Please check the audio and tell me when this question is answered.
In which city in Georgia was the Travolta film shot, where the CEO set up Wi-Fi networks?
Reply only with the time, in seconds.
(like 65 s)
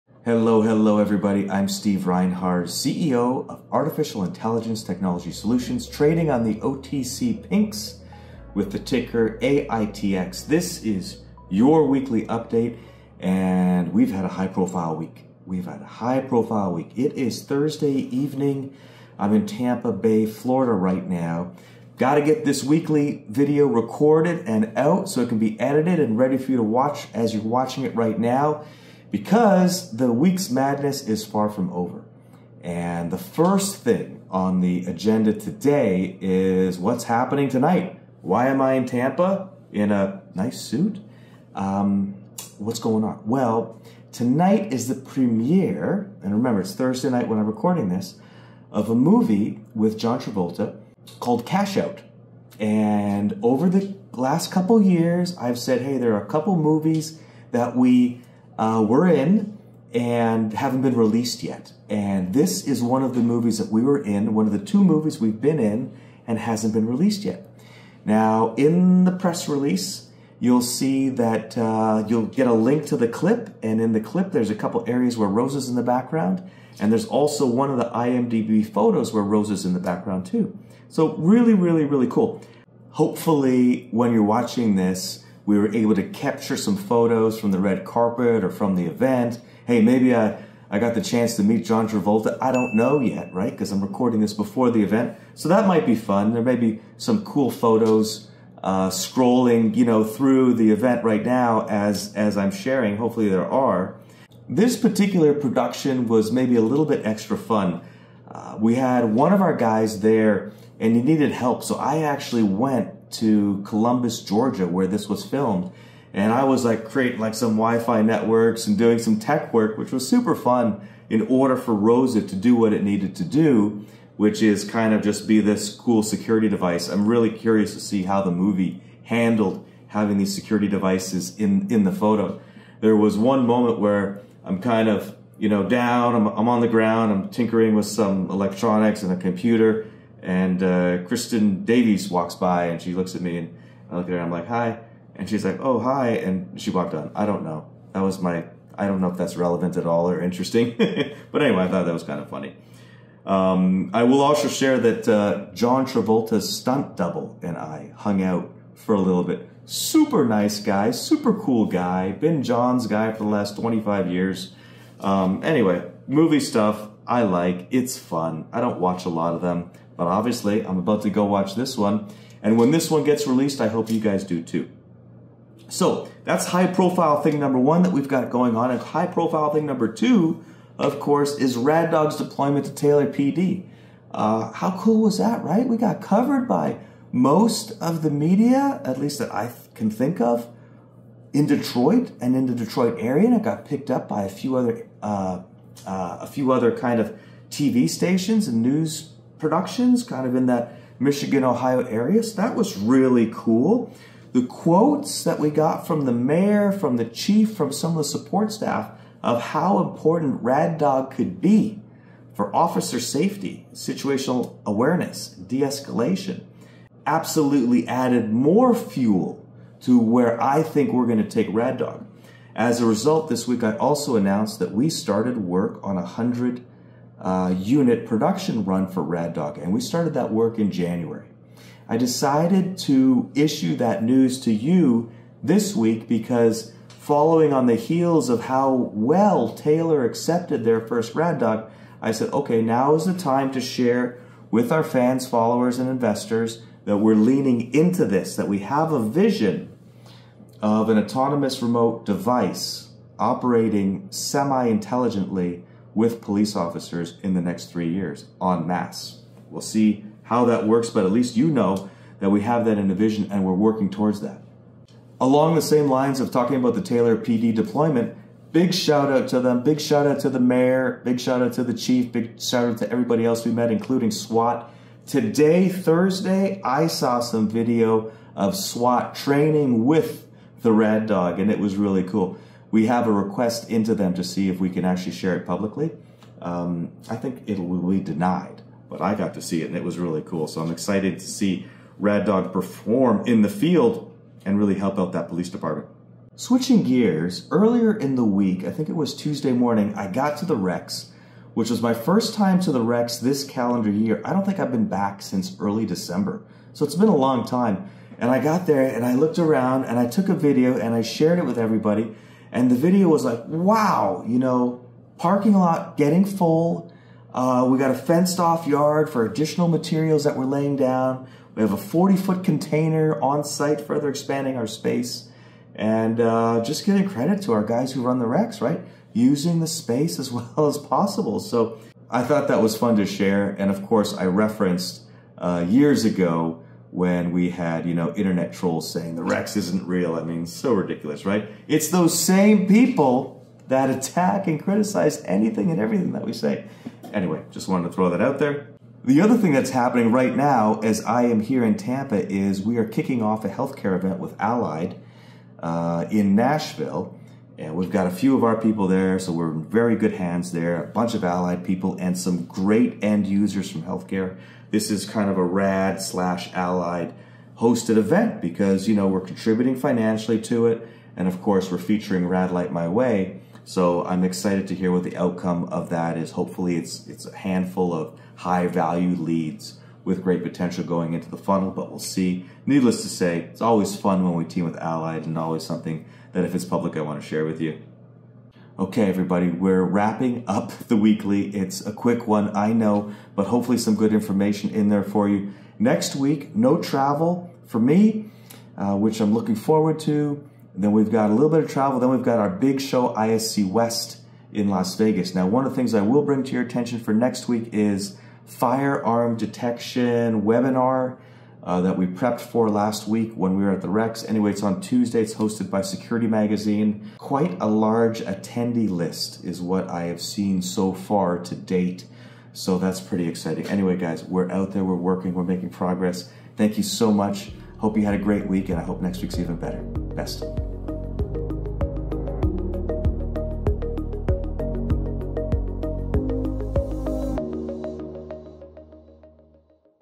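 113 s.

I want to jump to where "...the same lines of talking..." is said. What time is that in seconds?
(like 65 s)
265 s.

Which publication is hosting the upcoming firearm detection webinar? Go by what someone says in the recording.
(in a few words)
Security Magazine.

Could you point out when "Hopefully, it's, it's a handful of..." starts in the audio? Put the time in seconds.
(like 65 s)
376 s.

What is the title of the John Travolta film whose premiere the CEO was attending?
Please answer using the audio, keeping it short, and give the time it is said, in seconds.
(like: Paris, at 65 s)
Cash Out, at 51 s.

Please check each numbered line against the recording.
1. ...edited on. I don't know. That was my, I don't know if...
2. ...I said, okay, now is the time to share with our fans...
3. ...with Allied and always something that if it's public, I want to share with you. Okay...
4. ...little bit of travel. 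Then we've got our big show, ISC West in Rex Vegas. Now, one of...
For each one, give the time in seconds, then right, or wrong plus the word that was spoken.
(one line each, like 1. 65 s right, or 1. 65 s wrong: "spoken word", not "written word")
1. 146 s wrong: "walked", not "edited"
2. 242 s right
3. 384 s right
4. 401 s wrong: "Las", not "Rex".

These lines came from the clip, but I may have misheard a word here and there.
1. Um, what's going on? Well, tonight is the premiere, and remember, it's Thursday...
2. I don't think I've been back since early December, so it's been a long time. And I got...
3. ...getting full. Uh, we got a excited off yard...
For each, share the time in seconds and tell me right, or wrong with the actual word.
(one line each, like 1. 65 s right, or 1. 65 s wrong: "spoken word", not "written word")
1. 41 s right
2. 304 s right
3. 315 s wrong: "fenced", not "excited".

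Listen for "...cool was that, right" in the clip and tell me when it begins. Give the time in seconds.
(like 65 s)
184 s.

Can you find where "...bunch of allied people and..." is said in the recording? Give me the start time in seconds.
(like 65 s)
360 s.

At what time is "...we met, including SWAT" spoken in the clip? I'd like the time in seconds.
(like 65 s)
273 s.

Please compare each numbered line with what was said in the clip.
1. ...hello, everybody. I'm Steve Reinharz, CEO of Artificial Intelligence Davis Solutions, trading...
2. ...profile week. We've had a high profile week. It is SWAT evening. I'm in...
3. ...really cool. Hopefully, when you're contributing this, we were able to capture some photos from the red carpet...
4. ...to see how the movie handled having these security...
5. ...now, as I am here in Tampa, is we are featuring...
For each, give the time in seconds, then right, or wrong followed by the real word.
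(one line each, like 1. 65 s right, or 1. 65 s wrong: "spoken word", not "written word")
1. 0 s wrong: "Technology", not "Davis"
2. 14 s wrong: "Thursday", not "SWAT"
3. 81 s wrong: "watching", not "contributing"
4. 127 s right
5. 350 s wrong: "kicking", not "featuring".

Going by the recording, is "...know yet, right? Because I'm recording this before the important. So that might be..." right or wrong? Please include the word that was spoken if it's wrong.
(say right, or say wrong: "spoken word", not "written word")
wrong: "event", not "important".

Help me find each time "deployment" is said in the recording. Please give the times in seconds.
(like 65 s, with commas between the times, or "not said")
182 s, 267 s.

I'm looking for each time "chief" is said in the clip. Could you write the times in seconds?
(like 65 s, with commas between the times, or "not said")
207 s, 271 s.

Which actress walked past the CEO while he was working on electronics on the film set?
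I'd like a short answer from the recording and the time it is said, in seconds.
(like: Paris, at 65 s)
Kristin Davis, at 140 s.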